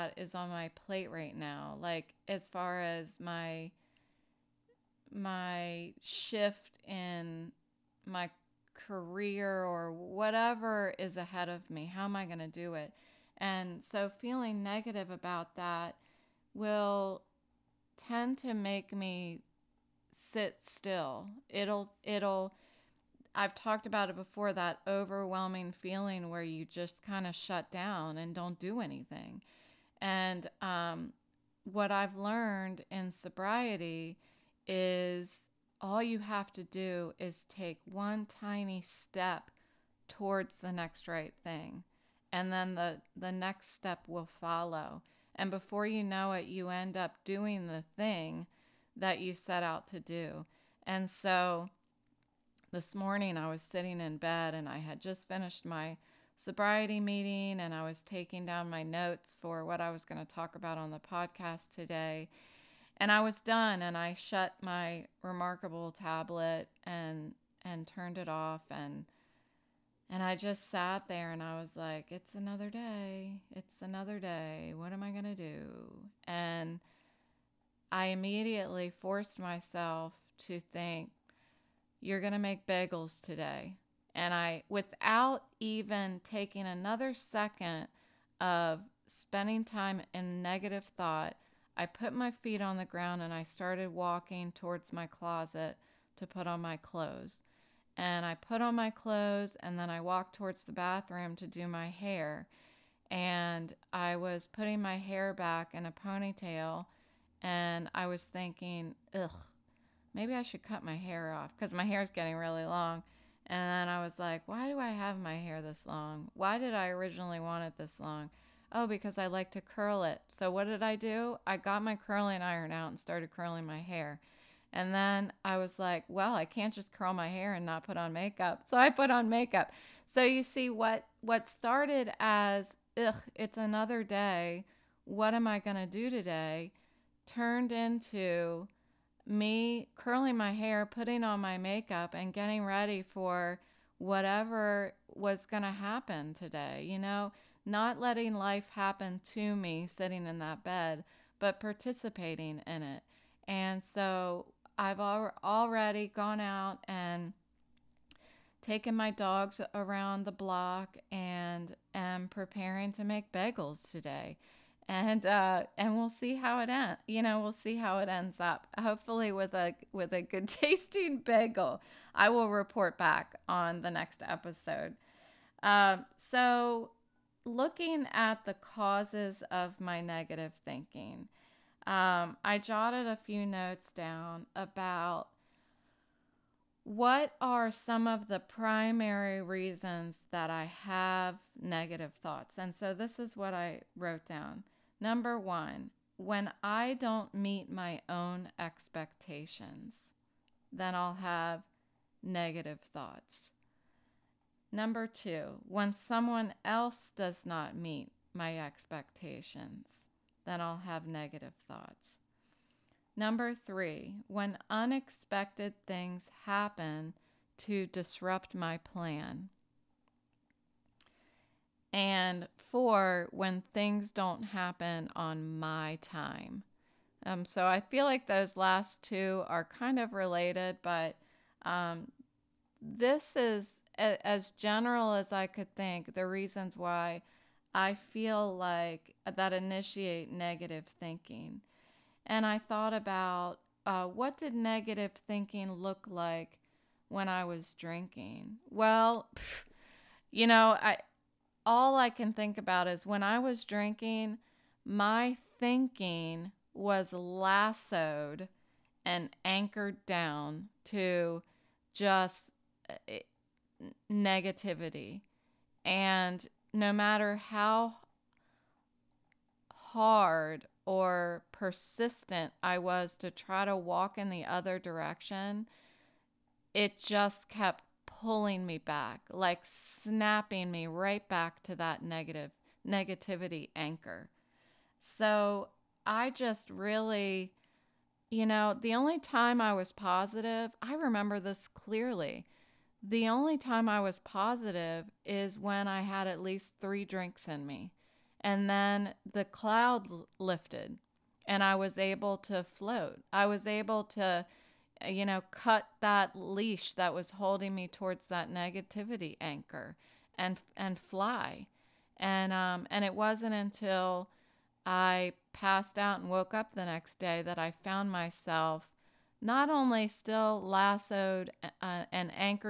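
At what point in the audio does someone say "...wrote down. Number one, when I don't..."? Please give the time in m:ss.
3:13.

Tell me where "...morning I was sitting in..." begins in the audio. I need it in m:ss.
0:52.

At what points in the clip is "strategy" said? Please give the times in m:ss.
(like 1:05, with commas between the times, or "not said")
not said.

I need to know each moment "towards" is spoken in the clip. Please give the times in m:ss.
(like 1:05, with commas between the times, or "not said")
0:40, 1:34, 1:40, 5:07.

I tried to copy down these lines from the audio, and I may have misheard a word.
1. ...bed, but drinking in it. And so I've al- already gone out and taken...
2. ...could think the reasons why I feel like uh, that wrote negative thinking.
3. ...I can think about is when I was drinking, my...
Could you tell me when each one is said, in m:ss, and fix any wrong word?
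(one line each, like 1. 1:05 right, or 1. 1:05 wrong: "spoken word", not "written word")
1. 2:30 wrong: "participating", not "drinking"
2. 3:55 wrong: "initiate", not "wrote"
3. 4:11 right.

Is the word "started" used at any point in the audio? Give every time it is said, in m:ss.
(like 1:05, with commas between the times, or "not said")
1:33, 2:02, 2:11.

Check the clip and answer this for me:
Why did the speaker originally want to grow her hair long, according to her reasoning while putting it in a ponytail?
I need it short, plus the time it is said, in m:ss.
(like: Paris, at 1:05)
To curl it, at 1:59.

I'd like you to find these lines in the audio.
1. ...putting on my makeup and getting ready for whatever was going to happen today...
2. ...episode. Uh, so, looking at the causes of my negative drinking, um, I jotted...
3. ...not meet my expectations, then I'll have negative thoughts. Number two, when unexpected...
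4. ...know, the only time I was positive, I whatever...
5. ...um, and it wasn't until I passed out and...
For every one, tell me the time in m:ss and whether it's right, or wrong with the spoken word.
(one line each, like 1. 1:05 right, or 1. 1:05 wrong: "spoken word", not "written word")
1. 2:20 right
2. 2:54 wrong: "thinking", not "drinking"
3. 3:27 wrong: "three", not "two"
4. 4:48 wrong: "remember", not "whatever"
5. 5:12 right.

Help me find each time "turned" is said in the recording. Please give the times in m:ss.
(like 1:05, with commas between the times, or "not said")
1:07, 2:17.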